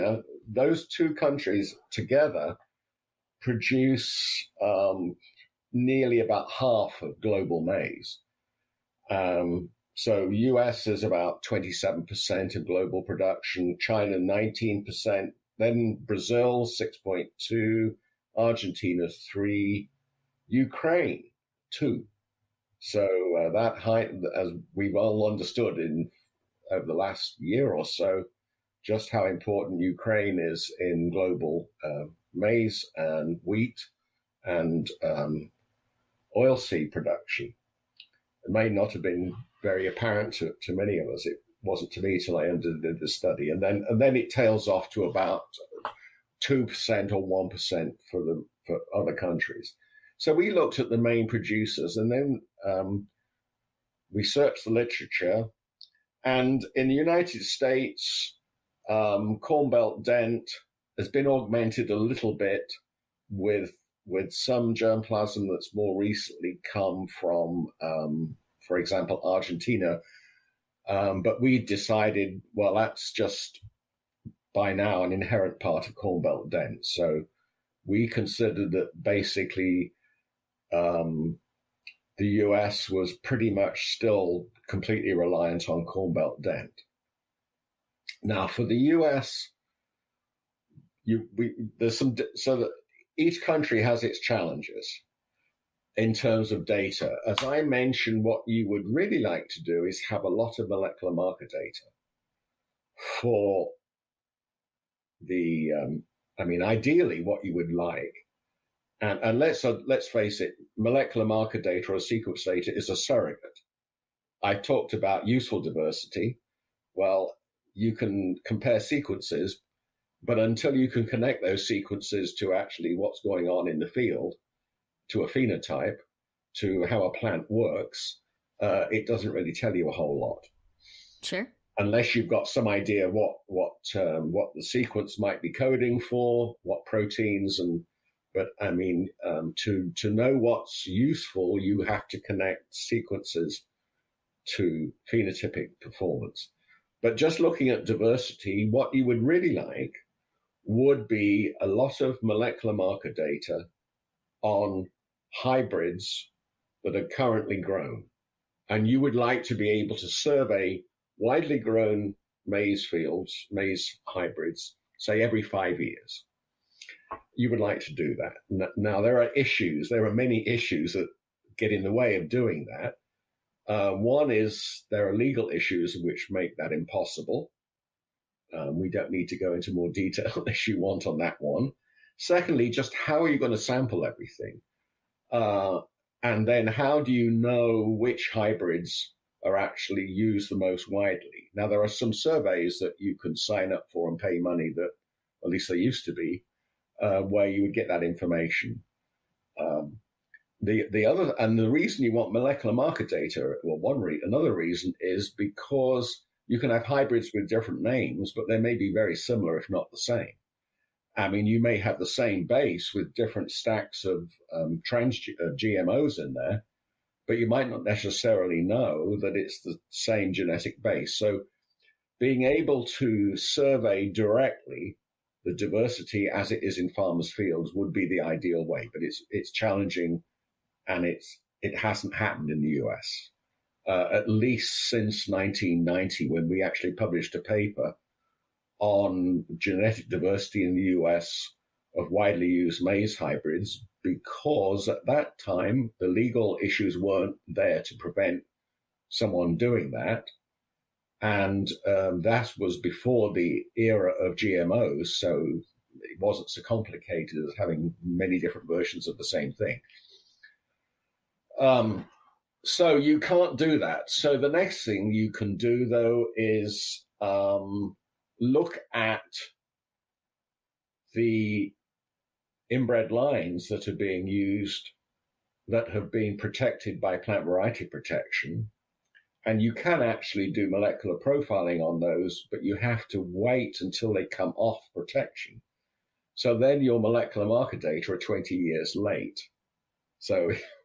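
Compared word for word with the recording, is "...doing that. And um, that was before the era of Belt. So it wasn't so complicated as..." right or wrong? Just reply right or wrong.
wrong.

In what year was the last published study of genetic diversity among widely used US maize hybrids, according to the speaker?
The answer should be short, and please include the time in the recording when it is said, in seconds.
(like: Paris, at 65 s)
1990, at 235 s.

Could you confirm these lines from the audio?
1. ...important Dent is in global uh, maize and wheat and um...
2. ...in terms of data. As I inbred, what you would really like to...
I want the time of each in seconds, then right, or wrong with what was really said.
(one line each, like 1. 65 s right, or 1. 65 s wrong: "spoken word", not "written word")
1. 29 s wrong: "Ukraine", not "Dent"
2. 95 s wrong: "mentioned", not "inbred".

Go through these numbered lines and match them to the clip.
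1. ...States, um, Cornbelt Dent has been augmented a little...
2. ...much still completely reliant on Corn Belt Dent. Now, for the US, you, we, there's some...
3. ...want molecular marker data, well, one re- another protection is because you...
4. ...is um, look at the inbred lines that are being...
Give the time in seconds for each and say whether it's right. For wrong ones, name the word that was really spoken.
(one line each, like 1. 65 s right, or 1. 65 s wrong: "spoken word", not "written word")
1. 57 s right
2. 83 s right
3. 202 s wrong: "reason", not "protection"
4. 266 s right.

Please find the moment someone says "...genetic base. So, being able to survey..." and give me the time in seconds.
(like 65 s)
220 s.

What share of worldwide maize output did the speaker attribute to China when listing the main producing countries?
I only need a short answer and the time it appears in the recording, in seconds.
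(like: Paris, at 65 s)
19%, at 13 s.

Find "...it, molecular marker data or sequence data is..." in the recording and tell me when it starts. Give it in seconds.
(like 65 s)
110 s.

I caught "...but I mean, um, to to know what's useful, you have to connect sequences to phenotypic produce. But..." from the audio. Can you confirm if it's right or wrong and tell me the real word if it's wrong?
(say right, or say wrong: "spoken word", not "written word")
wrong: "performance", not "produce".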